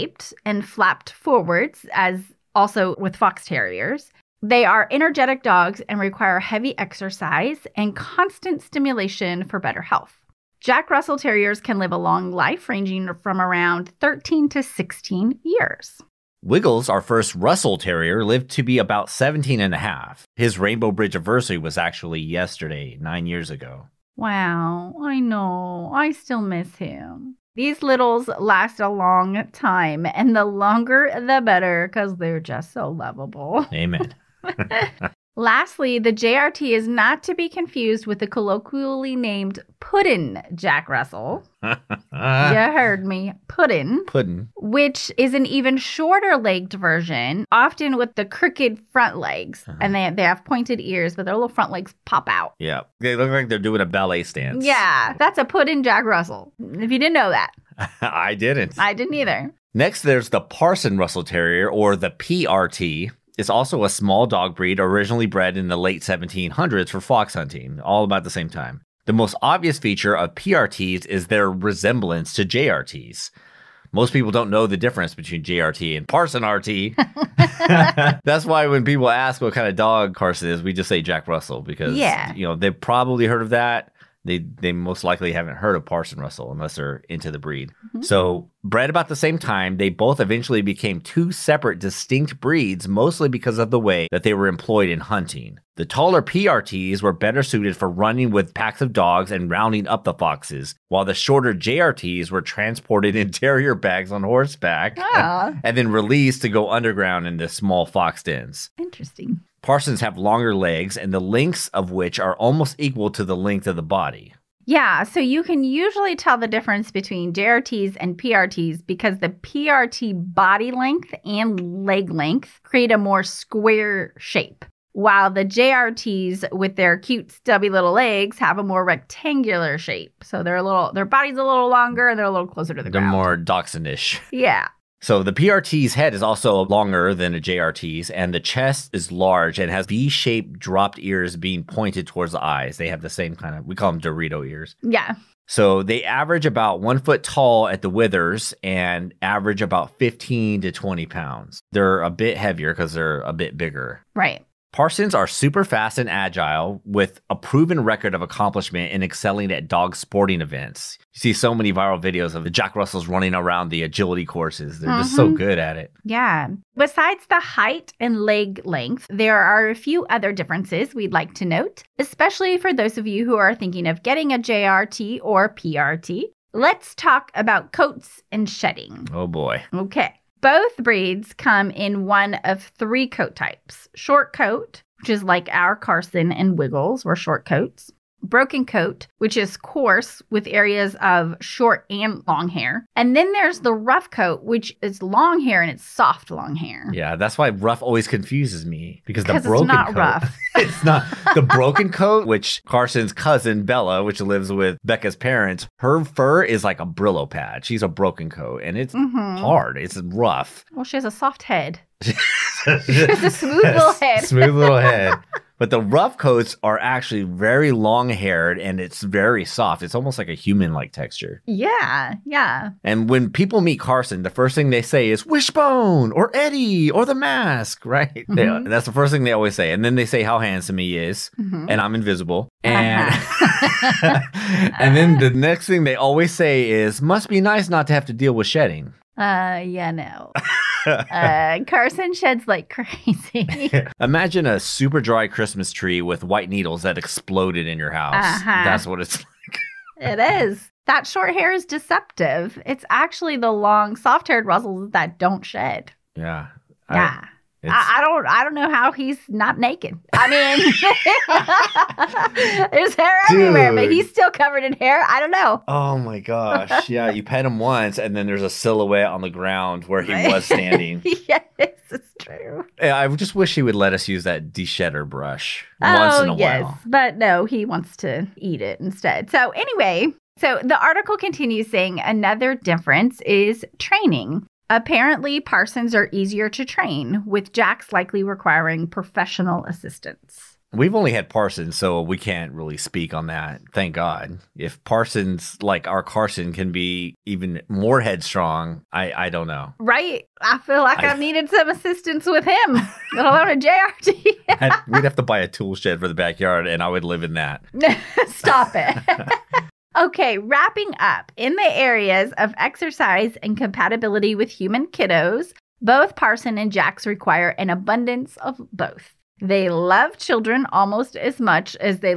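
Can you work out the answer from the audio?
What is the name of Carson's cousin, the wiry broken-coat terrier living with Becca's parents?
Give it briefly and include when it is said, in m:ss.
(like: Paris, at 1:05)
Bella, at 3:23.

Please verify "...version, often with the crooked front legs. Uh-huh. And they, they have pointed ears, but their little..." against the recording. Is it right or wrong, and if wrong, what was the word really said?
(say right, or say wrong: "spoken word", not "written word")
right.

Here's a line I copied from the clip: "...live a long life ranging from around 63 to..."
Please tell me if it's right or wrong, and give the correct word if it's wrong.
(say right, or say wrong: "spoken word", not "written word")
wrong: "13", not "63".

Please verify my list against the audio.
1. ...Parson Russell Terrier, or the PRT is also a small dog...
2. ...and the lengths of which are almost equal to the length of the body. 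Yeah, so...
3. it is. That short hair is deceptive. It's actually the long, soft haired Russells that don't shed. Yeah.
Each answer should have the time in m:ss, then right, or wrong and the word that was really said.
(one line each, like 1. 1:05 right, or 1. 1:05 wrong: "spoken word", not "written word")
1. 1:00 right
2. 1:50 right
3. 4:09 right.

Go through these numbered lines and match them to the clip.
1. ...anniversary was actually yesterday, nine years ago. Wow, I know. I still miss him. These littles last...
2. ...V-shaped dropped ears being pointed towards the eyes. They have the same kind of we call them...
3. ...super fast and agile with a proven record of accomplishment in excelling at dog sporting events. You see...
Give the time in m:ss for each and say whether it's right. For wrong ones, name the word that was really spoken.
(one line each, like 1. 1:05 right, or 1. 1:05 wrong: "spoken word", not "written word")
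1. 0:21 right
2. 2:19 right
3. 2:35 right.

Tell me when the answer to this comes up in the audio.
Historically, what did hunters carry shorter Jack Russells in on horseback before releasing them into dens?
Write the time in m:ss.
1:43.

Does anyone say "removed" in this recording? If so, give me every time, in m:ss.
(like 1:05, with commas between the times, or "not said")
not said.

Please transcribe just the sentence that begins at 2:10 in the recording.
So they're a little their body's a little longer and they're a little closer to the they're ground.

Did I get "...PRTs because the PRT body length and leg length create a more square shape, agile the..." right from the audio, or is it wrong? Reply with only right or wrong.
wrong.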